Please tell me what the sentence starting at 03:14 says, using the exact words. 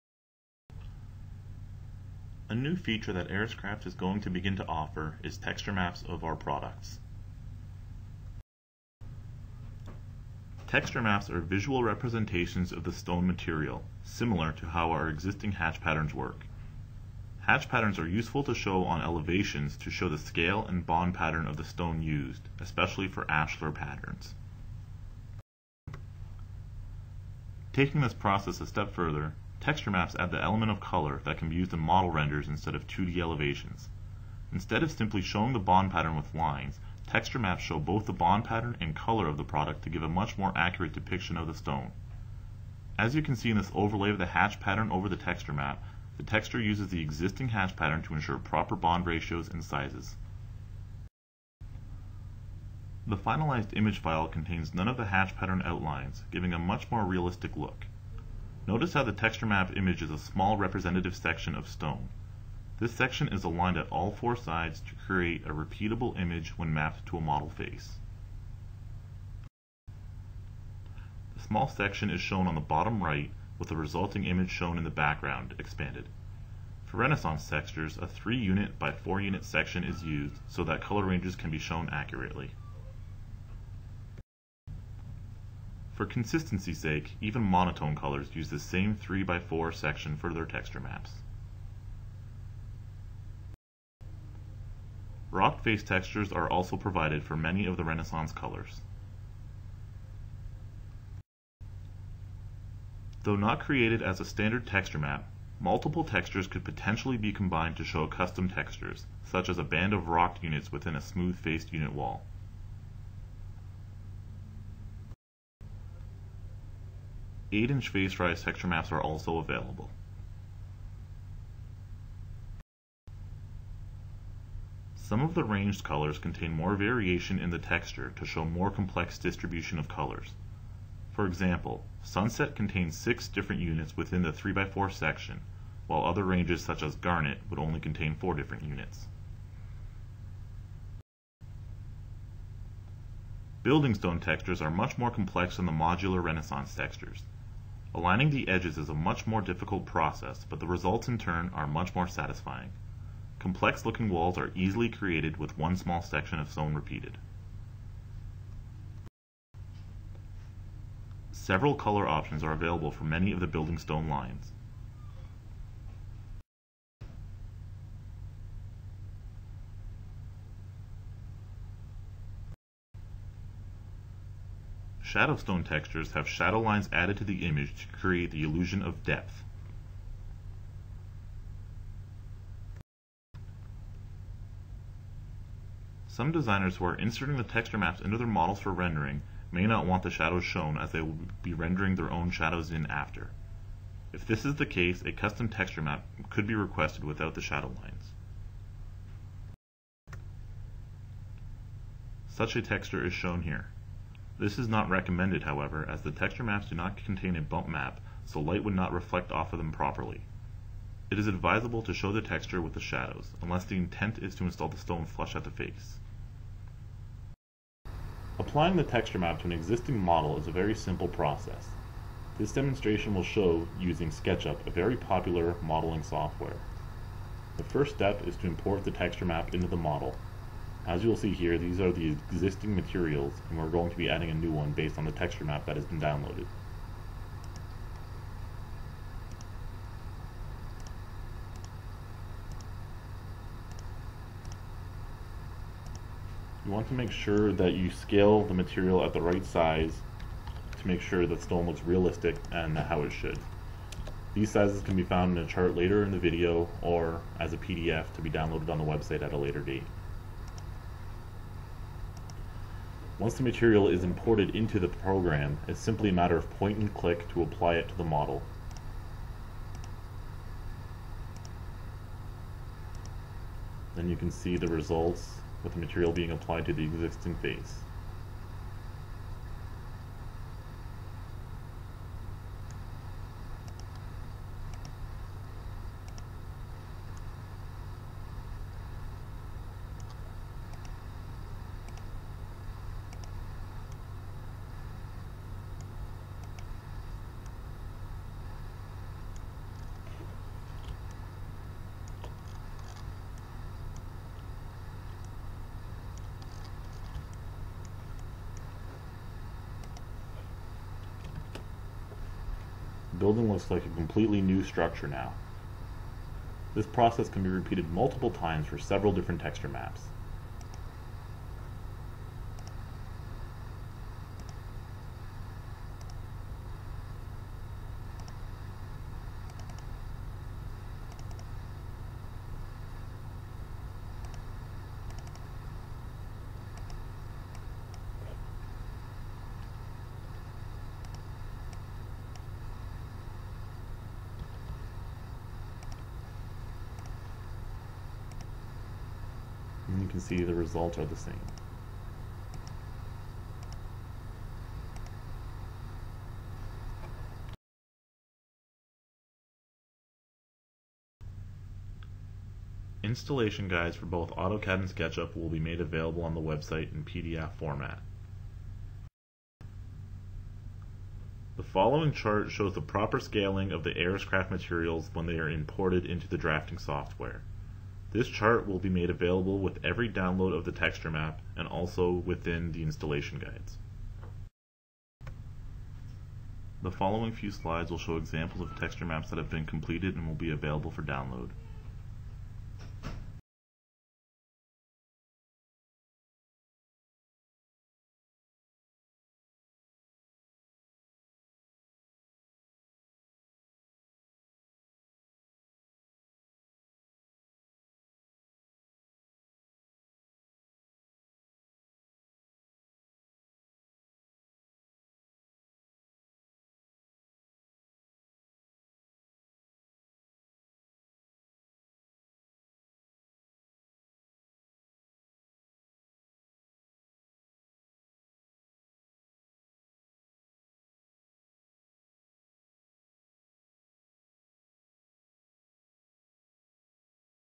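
If this is the case, a custom texture map could be requested without the shadow lines.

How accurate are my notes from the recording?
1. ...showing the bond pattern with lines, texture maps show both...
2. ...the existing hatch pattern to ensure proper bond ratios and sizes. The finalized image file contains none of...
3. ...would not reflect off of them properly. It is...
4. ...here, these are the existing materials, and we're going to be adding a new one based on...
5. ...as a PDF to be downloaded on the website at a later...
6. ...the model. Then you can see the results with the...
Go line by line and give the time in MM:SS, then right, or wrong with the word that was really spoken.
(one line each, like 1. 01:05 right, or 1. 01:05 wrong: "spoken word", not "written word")
1. 00:35 right
2. 00:46 right
3. 03:28 right
4. 03:51 right
5. 04:17 right
6. 04:27 right.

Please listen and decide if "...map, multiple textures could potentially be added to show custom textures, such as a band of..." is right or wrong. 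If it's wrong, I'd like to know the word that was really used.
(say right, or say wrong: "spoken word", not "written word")
wrong: "combined", not "added".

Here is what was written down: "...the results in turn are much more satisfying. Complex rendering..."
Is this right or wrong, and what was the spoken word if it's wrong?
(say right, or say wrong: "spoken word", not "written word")
wrong: "looking", not "rendering".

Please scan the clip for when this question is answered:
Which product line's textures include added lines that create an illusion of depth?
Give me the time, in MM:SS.
02:55.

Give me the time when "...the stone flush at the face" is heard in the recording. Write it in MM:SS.
03:34.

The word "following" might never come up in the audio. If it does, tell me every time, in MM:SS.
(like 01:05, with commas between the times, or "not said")
06:11, 06:26.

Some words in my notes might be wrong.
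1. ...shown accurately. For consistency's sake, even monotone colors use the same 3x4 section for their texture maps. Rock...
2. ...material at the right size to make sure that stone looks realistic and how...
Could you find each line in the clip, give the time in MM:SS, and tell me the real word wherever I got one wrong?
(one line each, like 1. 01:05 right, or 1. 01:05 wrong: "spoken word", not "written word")
1. 01:21 right
2. 04:08 right.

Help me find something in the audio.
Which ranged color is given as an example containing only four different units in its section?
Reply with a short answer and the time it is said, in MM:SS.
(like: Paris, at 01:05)
Garnet, at 02:16.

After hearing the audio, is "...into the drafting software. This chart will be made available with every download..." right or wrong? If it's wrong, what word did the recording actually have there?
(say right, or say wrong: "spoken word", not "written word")
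right.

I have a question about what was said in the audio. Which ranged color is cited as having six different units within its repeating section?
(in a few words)
Sunset.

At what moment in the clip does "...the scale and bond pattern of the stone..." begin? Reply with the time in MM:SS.
00:20.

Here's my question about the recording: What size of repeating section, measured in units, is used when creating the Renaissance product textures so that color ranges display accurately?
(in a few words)
3 unit by 4 unit.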